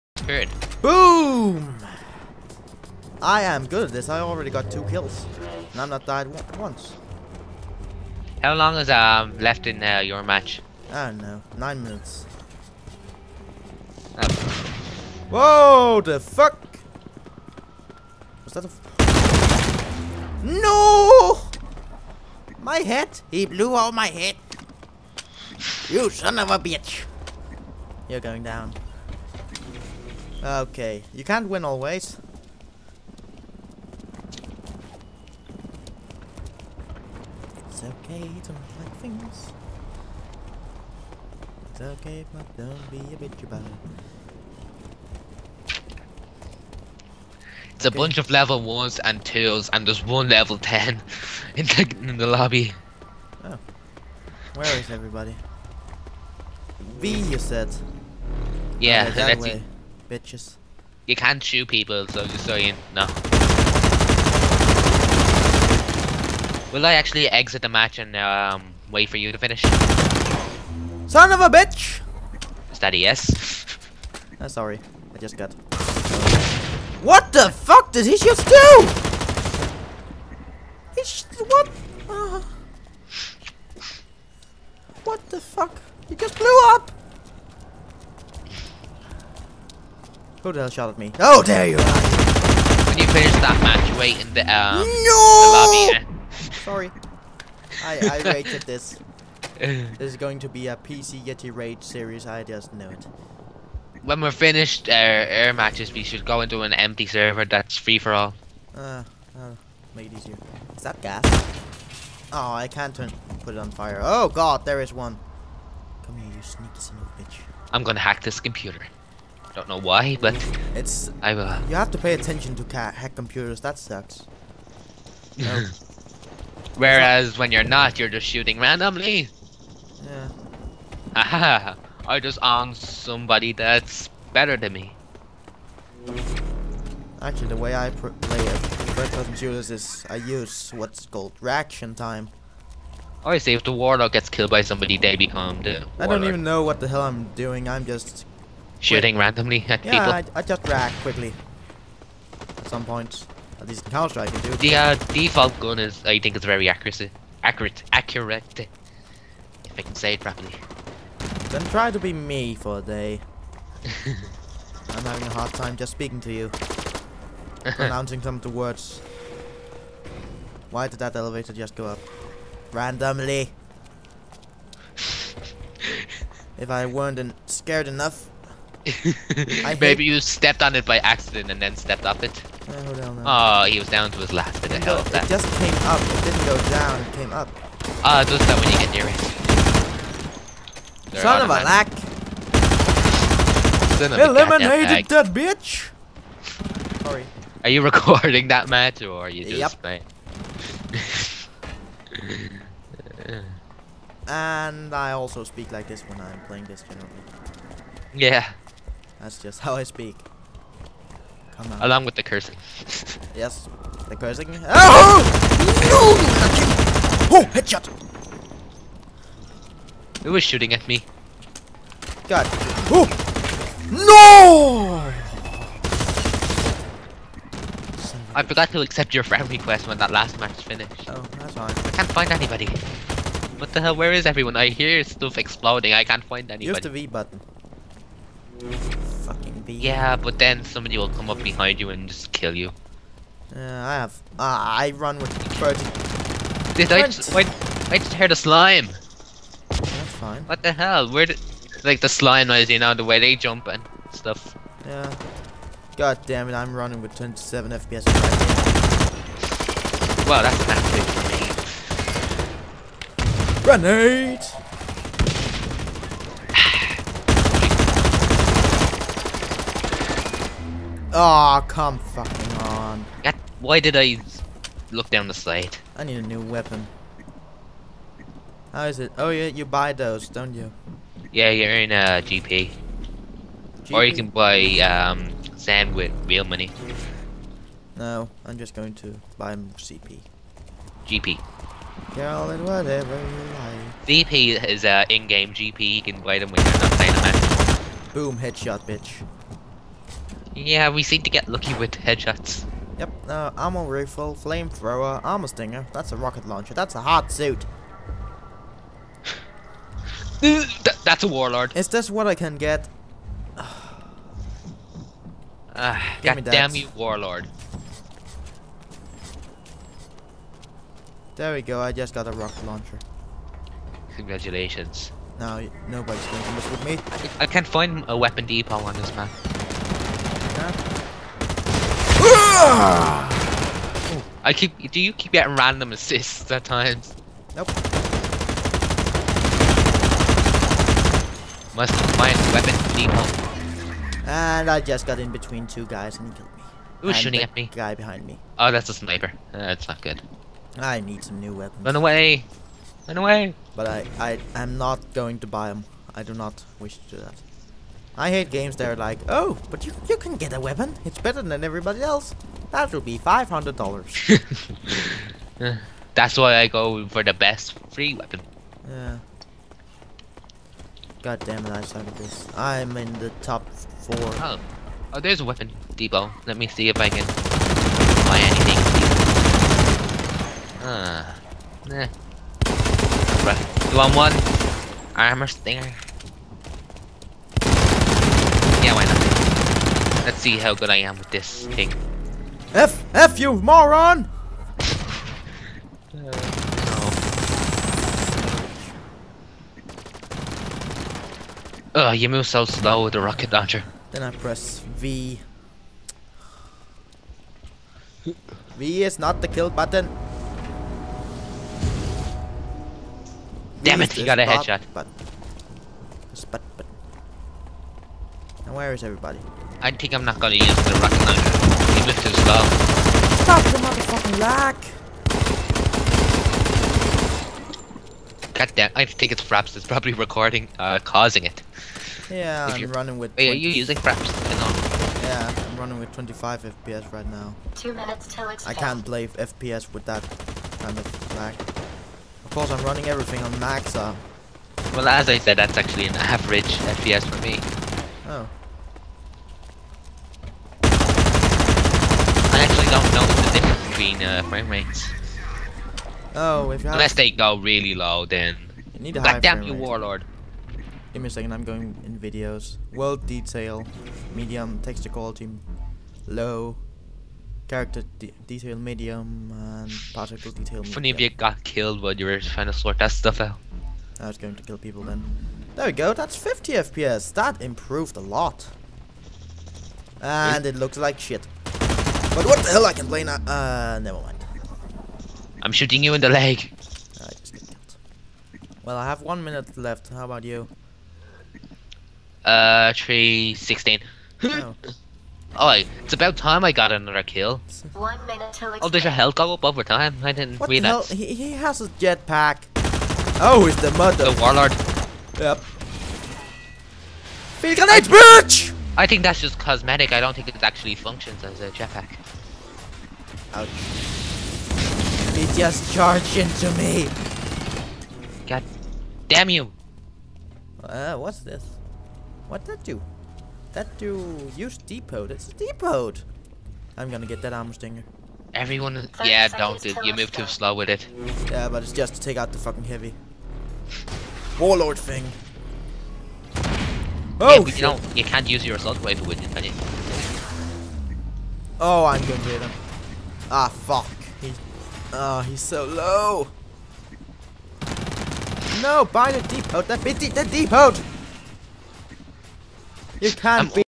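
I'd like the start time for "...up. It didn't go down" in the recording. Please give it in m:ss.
3:05.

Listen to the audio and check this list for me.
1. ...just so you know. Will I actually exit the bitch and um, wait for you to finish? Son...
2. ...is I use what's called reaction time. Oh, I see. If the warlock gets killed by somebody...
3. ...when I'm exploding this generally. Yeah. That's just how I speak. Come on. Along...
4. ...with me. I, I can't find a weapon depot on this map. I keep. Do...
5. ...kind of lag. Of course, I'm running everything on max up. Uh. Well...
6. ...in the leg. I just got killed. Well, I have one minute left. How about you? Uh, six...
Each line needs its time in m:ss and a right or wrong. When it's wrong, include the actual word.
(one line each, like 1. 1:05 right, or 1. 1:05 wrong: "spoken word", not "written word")
1. 1:02 wrong: "match", not "bitch"
2. 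2:19 right
3. 3:26 wrong: "playing", not "exploding"
4. 5:26 right
5. 7:20 right
6. 8:06 wrong: "three", not "six".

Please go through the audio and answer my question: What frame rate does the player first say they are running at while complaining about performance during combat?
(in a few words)
27 FPS.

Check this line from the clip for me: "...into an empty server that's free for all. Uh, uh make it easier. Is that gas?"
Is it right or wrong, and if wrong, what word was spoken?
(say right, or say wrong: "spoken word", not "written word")
right.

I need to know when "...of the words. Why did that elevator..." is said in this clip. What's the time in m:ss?
2:48.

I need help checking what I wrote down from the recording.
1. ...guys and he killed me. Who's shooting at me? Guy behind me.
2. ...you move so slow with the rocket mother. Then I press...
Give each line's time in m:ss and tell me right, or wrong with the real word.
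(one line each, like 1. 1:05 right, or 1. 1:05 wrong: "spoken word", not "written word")
1. 5:45 right
2. 6:42 wrong: "launcher", not "mother".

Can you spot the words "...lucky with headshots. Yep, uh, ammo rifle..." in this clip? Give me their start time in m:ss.
5:01.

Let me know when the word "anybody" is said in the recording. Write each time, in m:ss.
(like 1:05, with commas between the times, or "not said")
3:52, 3:56.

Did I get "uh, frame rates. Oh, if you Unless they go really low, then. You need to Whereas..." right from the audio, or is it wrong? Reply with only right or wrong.
wrong.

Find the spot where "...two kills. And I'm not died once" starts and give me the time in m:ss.
0:04.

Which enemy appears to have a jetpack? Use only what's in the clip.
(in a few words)
The warlord.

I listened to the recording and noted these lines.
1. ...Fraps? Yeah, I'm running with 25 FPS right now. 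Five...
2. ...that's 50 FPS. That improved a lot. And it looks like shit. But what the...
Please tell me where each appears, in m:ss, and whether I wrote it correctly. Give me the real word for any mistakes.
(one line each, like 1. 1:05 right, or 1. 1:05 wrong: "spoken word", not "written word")
1. 7:13 wrong: "Two", not "Five"
2. 7:56 right.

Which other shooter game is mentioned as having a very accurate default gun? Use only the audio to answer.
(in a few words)
Counter Strike.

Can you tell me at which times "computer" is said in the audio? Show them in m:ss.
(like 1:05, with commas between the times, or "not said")
1:58, 2:03.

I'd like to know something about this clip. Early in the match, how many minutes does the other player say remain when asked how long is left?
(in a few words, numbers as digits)
9 minutes.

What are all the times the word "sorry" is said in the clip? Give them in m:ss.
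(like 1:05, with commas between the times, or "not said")
1:14, 1:36, 3:17.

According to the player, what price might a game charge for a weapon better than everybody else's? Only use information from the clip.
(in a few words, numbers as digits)
$500.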